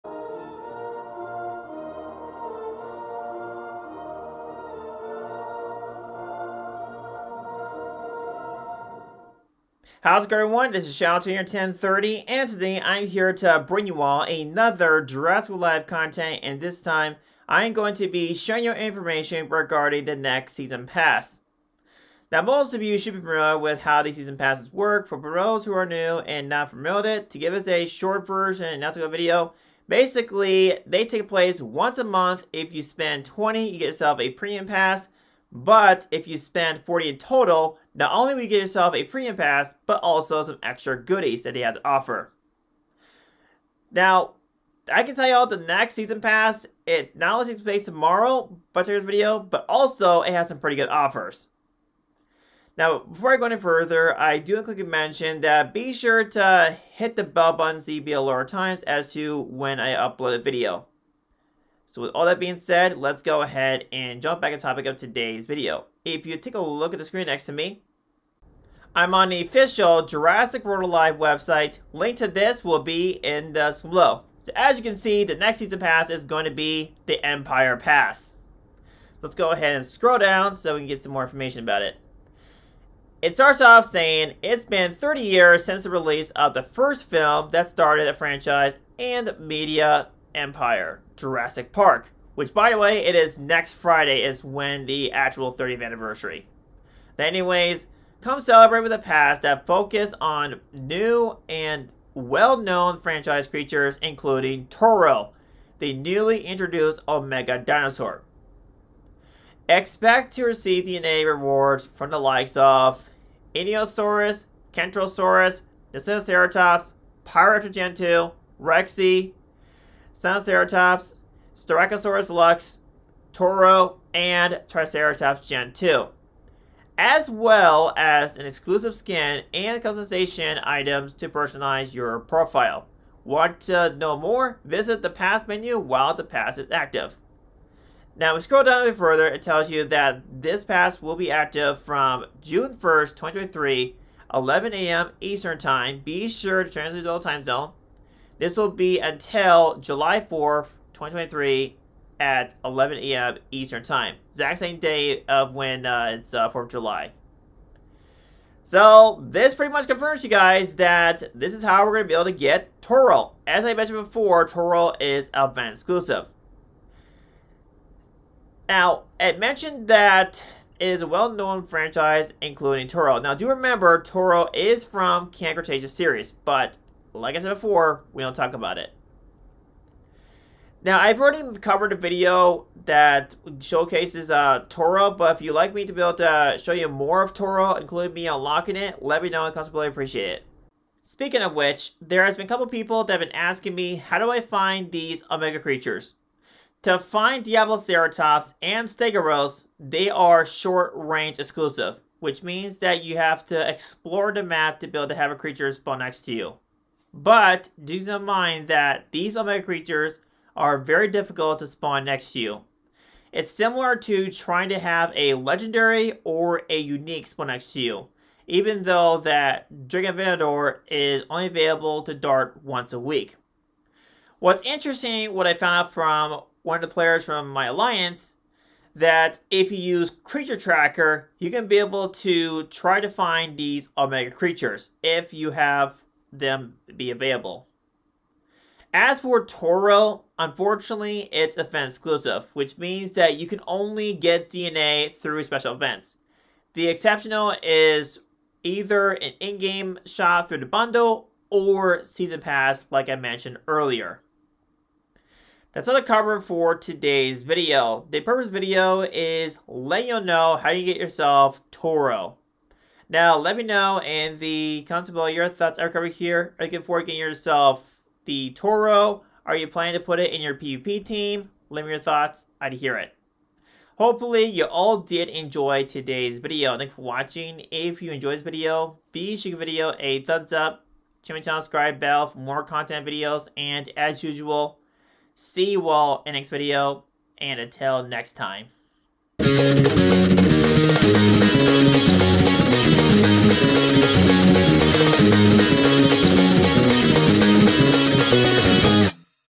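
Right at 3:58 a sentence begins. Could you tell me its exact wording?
As for Toro, unfortunately, it's event exclusive, which means that you can only get DNA through special events.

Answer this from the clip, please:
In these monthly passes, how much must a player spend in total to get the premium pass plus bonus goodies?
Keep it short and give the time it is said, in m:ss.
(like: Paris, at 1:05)
40, at 0:36.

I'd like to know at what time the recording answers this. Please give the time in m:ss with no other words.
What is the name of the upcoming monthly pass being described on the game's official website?
1:17.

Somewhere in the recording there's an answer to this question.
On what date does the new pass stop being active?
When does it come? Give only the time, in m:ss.
2:29.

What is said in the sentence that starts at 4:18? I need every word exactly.
The purpose video is letting you know how you get yourself Toro.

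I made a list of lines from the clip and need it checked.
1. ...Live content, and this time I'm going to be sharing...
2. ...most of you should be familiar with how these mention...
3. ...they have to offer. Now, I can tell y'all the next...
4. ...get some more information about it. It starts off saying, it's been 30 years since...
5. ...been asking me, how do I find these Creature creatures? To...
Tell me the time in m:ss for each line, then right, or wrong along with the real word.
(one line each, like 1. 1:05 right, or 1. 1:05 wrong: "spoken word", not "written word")
1. 0:15 right
2. 0:22 wrong: "season", not "mention"
3. 0:41 right
4. 1:20 right
5. 3:13 wrong: "Omega", not "Creature".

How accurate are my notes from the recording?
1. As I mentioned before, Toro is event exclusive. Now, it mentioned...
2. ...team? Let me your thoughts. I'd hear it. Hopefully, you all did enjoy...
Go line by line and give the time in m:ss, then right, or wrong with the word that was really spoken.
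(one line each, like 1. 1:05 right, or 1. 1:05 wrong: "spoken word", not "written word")
1. 2:43 right
2. 4:31 right.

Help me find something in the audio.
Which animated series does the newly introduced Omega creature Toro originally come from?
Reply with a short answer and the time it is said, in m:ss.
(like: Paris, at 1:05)
Camp Cretaceous, at 2:55.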